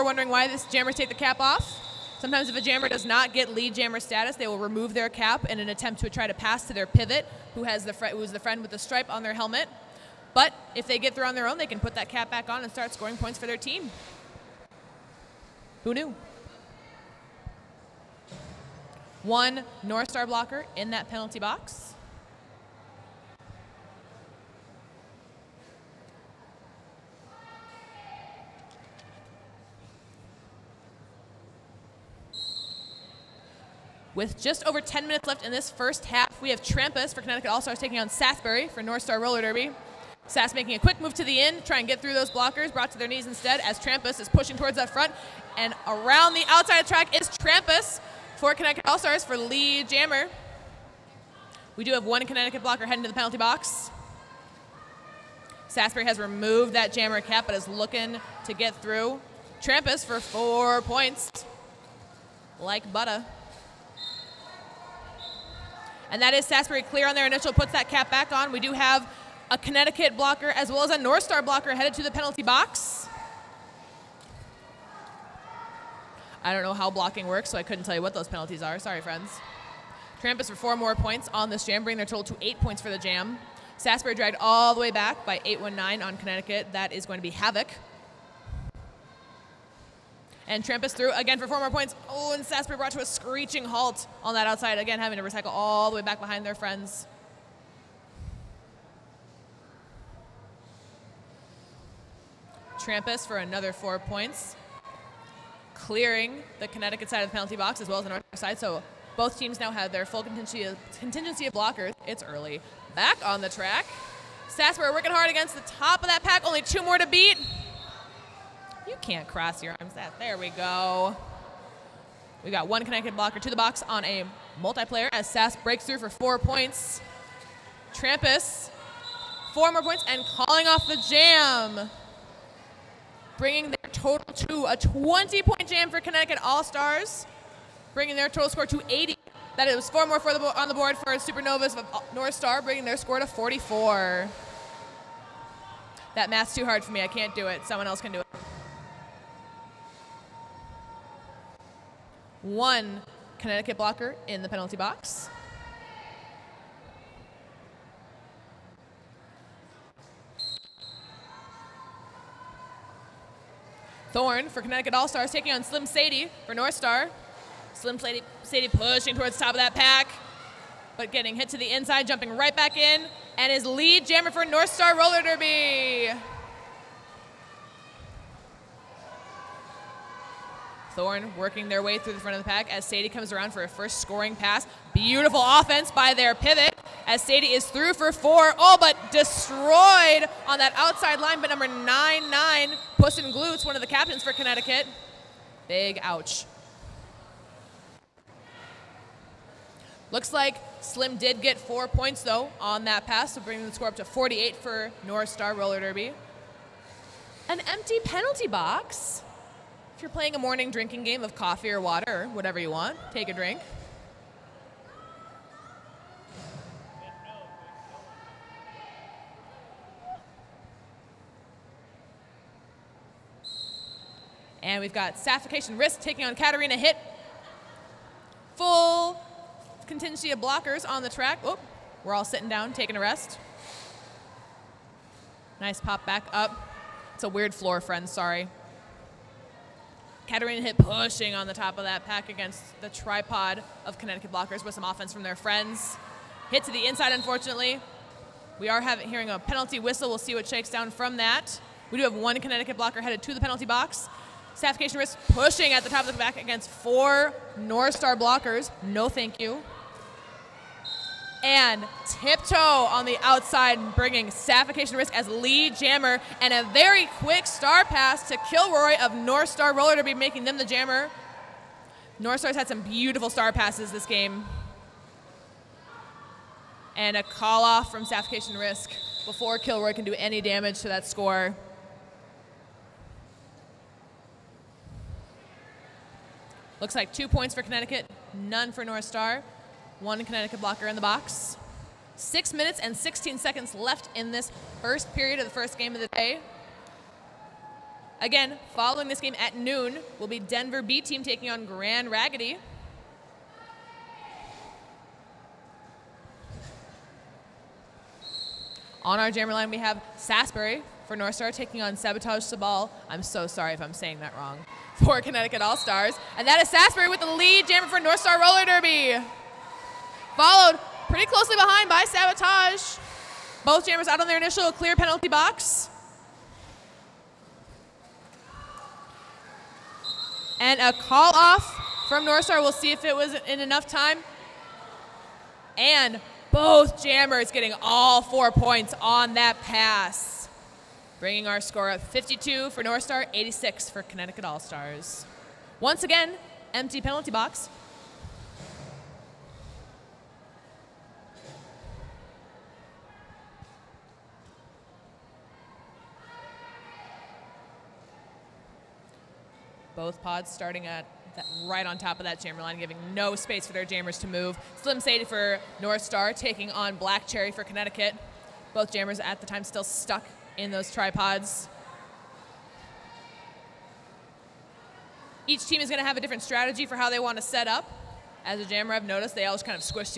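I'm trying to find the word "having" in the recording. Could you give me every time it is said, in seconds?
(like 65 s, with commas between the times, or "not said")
94 s, 248 s.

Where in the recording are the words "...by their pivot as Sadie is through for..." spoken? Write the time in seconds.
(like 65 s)
185 s.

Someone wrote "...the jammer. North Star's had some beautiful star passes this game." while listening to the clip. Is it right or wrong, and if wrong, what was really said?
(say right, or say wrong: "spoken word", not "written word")
right.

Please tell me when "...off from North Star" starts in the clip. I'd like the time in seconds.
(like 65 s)
331 s.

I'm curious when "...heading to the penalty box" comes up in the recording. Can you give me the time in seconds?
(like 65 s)
52 s.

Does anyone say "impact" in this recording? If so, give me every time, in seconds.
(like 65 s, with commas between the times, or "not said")
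not said.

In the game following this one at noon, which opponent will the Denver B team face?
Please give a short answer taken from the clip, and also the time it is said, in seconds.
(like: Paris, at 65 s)
Grand Raggidy, at 301 s.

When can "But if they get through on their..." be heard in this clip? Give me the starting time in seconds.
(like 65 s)
10 s.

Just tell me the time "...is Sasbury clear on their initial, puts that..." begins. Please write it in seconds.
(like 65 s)
66 s.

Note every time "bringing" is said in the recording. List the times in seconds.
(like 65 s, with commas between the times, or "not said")
81 s, 133 s, 137 s, 142 s, 203 s, 263 s, 341 s.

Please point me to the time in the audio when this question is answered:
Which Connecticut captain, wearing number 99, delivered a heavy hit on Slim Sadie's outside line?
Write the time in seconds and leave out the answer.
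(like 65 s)
192 s.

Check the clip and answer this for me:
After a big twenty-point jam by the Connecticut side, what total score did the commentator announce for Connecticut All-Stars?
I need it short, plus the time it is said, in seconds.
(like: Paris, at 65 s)
80, at 138 s.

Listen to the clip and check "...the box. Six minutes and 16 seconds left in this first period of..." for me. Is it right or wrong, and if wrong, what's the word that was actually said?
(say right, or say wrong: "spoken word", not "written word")
right.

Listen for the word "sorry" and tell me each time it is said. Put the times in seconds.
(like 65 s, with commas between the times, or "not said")
78 s, 238 s, 313 s.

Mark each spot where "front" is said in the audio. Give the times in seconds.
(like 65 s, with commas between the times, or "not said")
44 s, 182 s.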